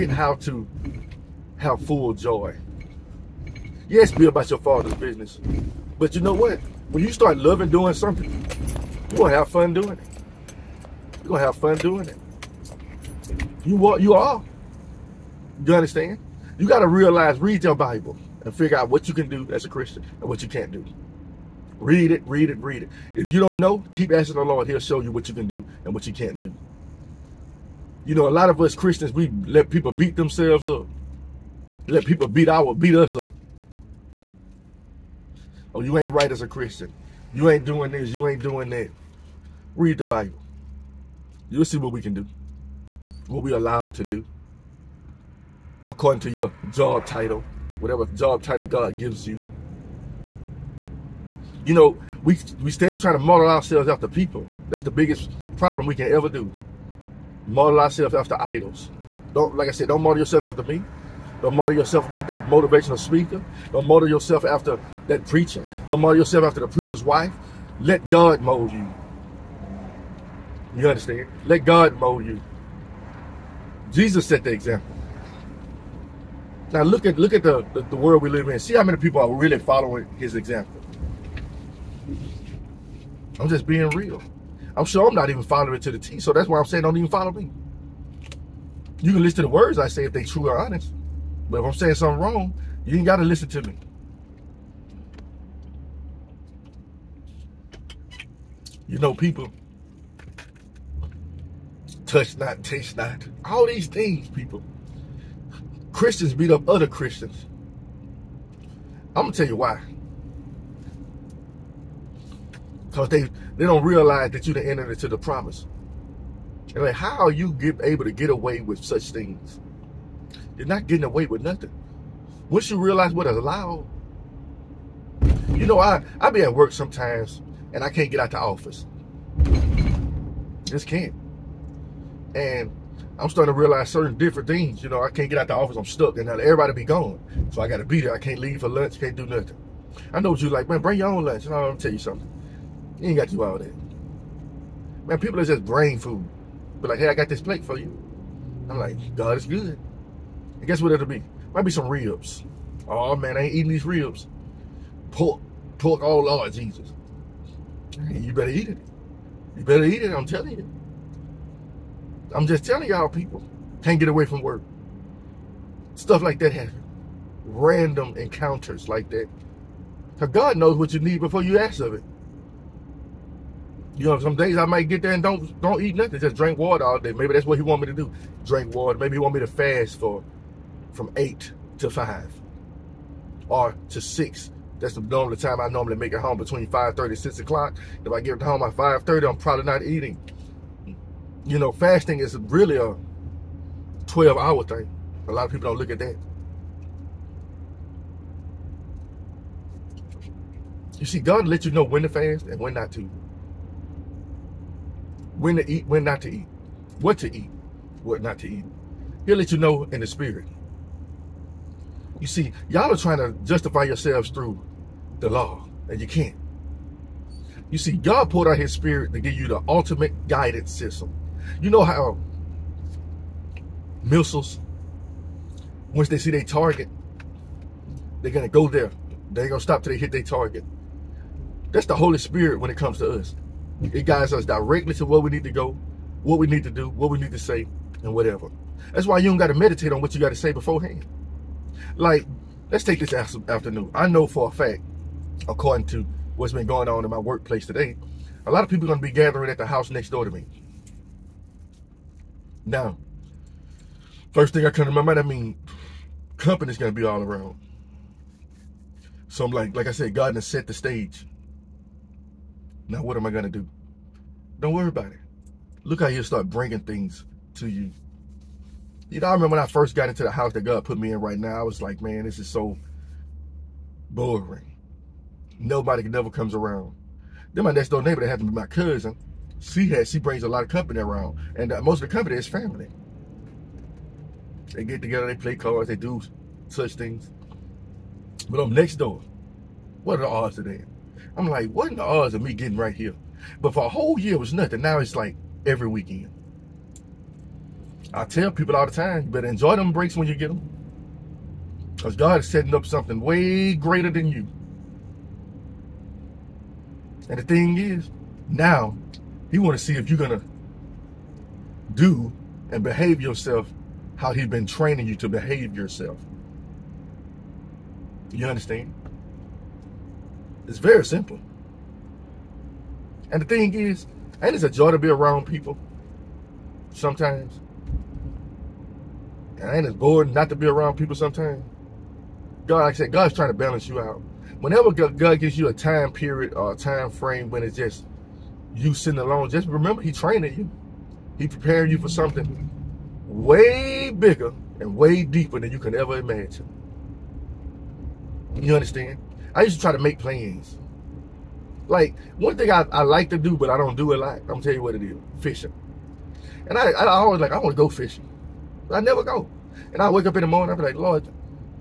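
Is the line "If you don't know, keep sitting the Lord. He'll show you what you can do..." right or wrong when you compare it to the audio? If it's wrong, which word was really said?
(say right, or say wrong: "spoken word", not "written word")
wrong: "asking", not "sitting".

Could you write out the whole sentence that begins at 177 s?
Maybe that's what he want me to do.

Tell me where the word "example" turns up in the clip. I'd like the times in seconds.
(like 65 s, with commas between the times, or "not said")
74 s, 80 s.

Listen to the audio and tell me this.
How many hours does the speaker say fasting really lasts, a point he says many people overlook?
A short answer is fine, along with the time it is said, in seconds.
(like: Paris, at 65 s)
12, at 194 s.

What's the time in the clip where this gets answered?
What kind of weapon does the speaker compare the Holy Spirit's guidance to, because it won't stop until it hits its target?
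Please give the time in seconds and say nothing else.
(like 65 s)
224 s.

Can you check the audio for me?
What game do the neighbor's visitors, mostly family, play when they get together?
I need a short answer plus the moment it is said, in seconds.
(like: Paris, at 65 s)
Cards, at 285 s.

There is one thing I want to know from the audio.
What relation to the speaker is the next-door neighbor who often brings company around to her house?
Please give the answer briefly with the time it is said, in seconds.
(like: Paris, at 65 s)
Cousin, at 278 s.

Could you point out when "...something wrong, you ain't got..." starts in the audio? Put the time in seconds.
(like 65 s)
91 s.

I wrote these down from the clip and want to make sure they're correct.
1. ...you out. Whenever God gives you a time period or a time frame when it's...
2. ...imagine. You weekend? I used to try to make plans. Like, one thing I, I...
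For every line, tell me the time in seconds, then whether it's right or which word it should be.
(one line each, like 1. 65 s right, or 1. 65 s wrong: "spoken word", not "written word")
1. 333 s right
2. 346 s wrong: "understand", not "weekend".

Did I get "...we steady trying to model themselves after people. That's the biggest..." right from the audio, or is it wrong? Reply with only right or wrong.
wrong.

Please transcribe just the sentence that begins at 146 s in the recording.
Be like, hey, I got this plate for you.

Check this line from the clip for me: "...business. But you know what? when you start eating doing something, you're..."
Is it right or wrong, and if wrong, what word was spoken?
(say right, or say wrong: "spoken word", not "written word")
wrong: "loving", not "eating".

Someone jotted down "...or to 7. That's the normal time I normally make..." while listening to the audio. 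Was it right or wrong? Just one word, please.
wrong.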